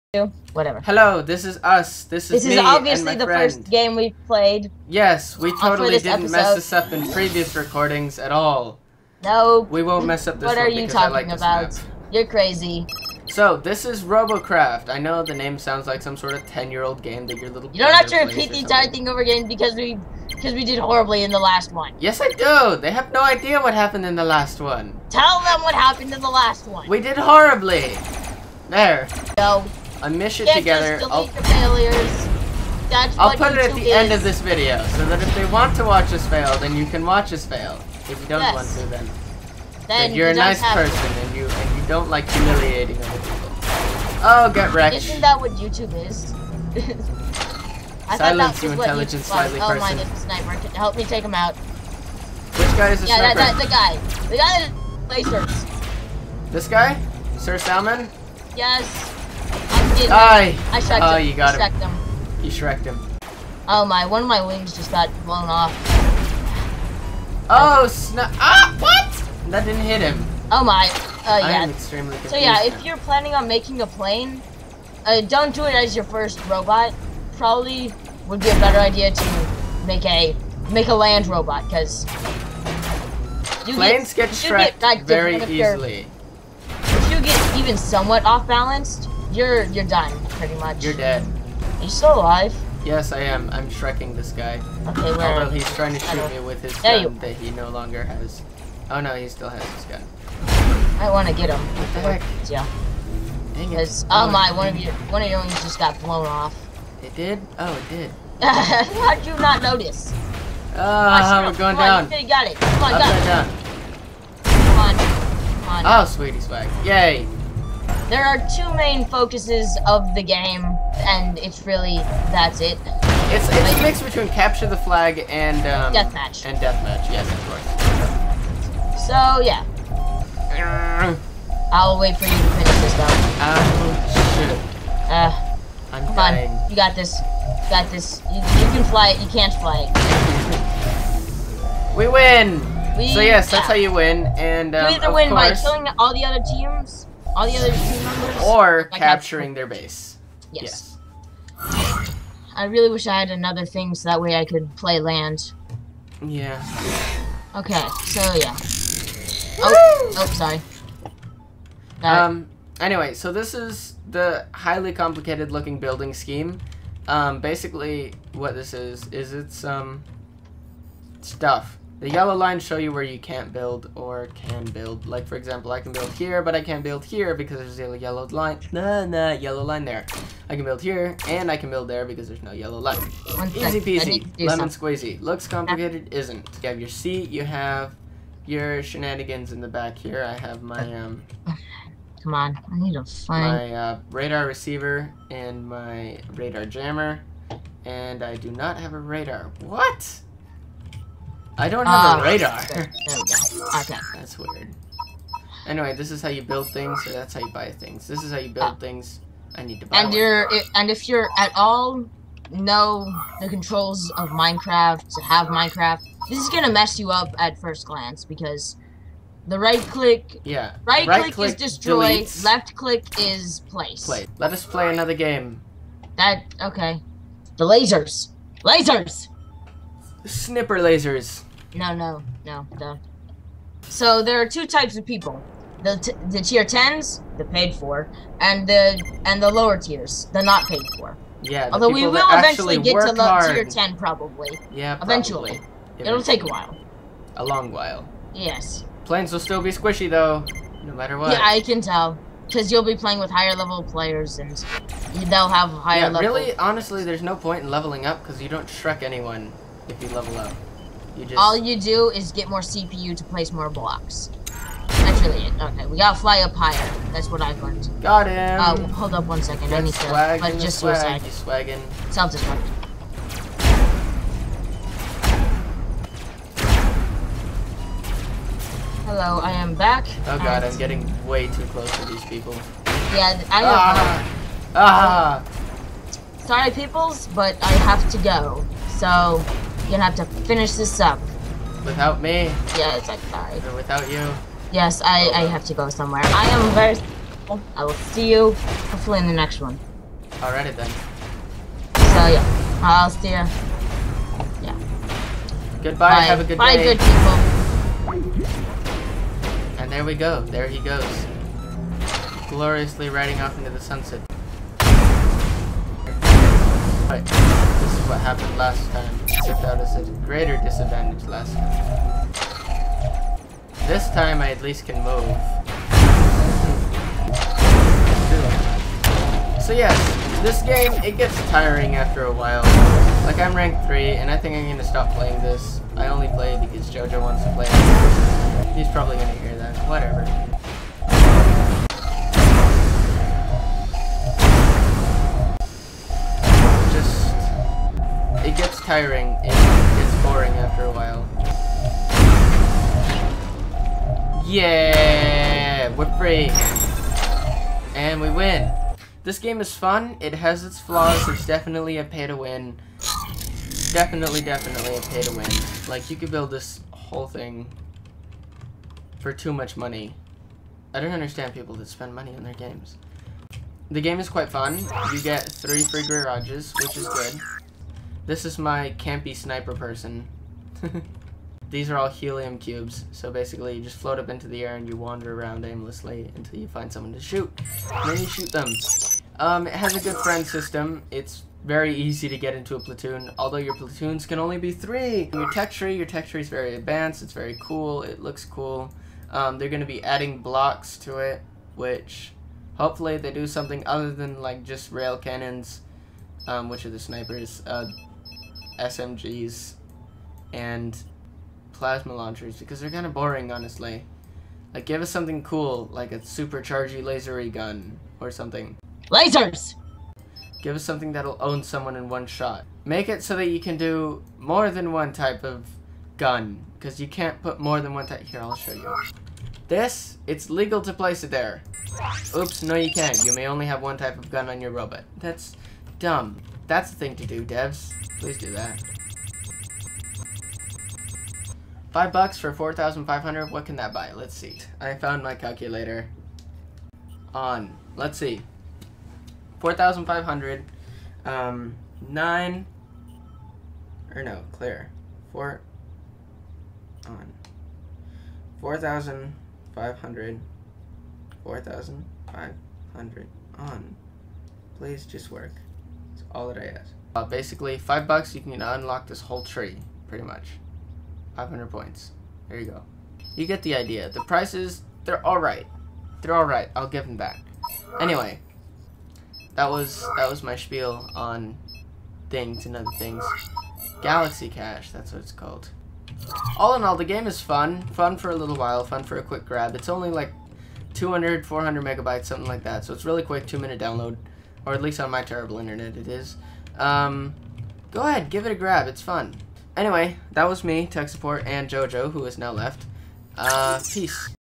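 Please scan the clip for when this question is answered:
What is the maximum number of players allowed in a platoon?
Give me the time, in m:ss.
6:33.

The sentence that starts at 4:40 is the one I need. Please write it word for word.
Oh god, I'm getting way too close to these people.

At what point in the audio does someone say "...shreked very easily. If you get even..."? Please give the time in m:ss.
1:24.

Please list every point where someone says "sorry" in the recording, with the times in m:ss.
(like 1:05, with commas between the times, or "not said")
2:40, 4:46, 4:53.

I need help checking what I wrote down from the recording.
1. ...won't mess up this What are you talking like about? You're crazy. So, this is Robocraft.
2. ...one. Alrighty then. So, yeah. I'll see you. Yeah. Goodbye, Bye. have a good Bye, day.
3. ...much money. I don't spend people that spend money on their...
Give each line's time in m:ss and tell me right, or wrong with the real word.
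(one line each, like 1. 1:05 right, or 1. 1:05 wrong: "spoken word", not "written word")
1. 0:09 right
2. 4:59 right
3. 6:09 wrong: "understand", not "spend".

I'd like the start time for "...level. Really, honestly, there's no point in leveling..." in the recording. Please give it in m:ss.
4:16.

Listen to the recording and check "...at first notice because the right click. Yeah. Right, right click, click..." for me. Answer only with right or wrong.
wrong.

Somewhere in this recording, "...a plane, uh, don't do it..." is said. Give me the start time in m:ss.
1:13.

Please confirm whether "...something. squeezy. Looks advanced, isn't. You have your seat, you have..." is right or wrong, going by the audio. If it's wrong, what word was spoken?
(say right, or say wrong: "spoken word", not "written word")
wrong: "complicated", not "advanced".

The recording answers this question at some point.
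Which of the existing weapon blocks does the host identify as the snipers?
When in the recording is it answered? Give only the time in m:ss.
6:44.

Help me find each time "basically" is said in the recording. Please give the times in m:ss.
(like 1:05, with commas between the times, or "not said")
2:47, 6:23, 7:47.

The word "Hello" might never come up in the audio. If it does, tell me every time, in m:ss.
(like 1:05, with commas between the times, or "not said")
0:00, 4:39.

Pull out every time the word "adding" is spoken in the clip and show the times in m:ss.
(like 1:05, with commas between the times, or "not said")
6:40.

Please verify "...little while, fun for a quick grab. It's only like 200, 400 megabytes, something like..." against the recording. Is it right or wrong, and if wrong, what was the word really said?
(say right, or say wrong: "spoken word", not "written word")
right.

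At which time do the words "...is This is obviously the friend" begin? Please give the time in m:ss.
0:02.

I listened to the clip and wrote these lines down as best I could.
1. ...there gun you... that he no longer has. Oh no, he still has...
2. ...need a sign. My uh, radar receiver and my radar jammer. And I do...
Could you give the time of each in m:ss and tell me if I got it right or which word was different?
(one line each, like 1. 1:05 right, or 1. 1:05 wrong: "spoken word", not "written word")
1. 1:36 right
2. 3:12 right.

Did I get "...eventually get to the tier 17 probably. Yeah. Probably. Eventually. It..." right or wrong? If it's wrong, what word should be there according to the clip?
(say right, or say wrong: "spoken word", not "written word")
wrong: "10", not "17".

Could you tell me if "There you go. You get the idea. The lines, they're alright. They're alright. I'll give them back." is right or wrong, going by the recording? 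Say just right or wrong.
wrong.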